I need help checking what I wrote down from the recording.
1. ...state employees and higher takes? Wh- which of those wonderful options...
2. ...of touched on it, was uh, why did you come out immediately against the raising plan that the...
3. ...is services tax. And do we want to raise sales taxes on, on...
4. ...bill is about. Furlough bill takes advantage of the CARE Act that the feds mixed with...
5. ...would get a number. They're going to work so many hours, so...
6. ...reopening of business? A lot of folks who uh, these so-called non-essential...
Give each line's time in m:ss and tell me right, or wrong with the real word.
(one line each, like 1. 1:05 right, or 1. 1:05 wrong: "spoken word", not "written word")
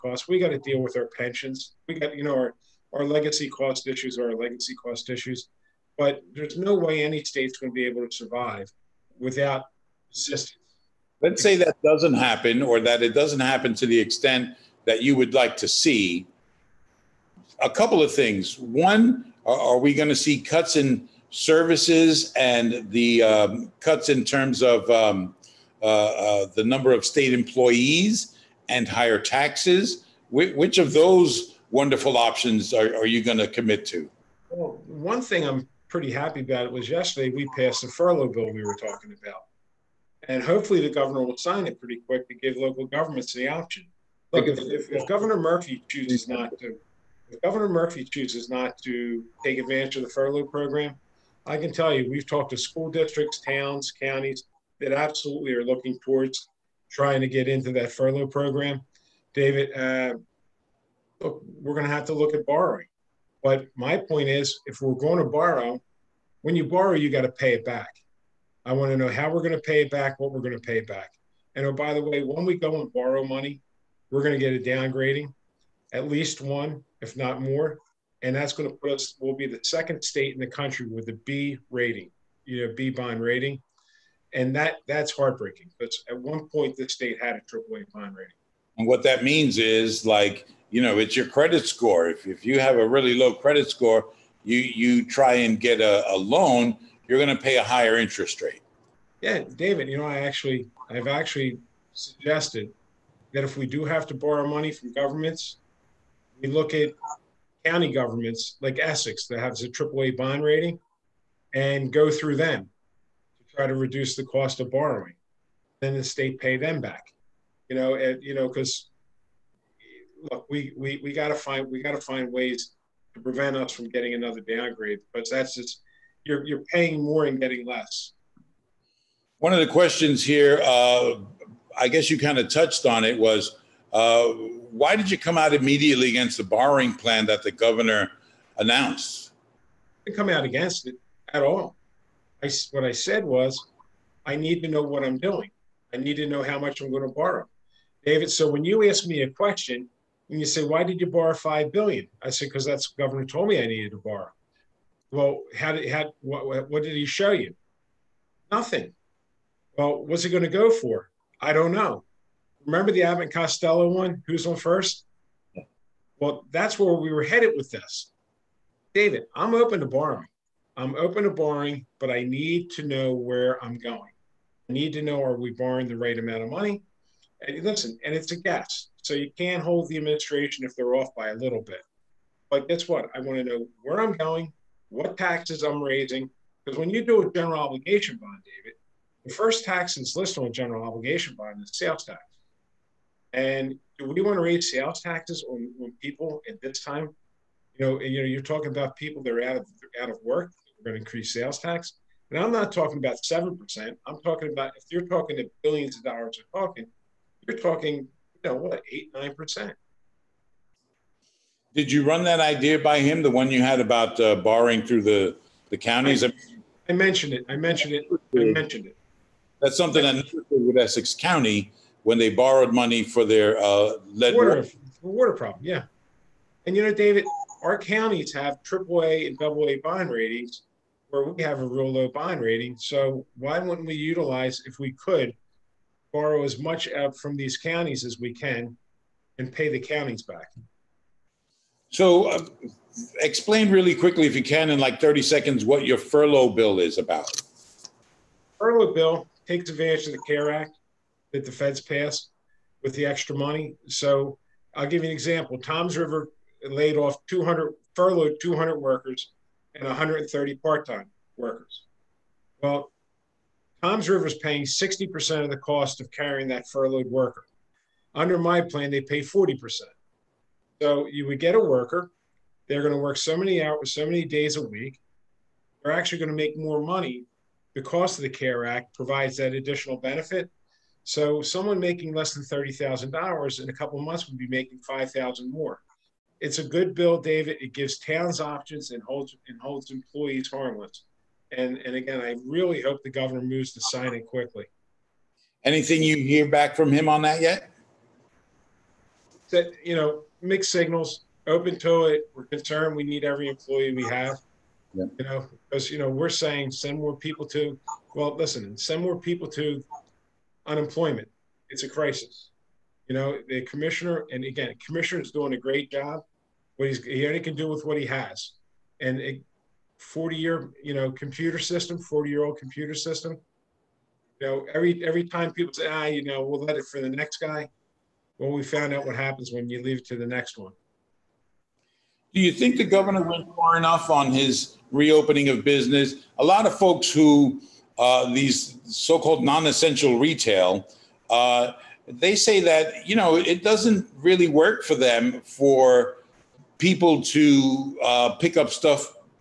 1. 0:27 wrong: "taxes", not "takes"
2. 2:12 wrong: "borrowing", not "raising"
3. 3:11 wrong: "sales", not "services"
4. 4:06 wrong: "passed", not "mixed"
5. 4:31 wrong: "worker", not "number"
6. 5:34 right.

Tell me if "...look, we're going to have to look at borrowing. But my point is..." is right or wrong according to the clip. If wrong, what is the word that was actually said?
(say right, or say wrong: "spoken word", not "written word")
right.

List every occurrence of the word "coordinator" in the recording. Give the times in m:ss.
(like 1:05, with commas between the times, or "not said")
not said.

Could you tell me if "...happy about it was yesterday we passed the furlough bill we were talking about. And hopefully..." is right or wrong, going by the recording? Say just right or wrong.
right.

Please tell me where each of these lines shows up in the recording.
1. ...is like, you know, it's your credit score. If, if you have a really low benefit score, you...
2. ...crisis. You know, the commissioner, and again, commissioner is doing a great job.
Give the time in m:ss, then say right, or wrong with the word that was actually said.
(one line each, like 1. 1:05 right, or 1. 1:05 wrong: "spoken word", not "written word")
1. 1:29 wrong: "credit", not "benefit"
2. 5:11 right.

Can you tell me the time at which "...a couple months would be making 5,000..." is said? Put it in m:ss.
4:43.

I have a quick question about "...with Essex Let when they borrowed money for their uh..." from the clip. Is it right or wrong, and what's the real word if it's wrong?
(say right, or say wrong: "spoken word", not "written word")
wrong: "County", not "Let".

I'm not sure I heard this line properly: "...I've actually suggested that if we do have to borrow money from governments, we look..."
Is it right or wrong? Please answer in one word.
right.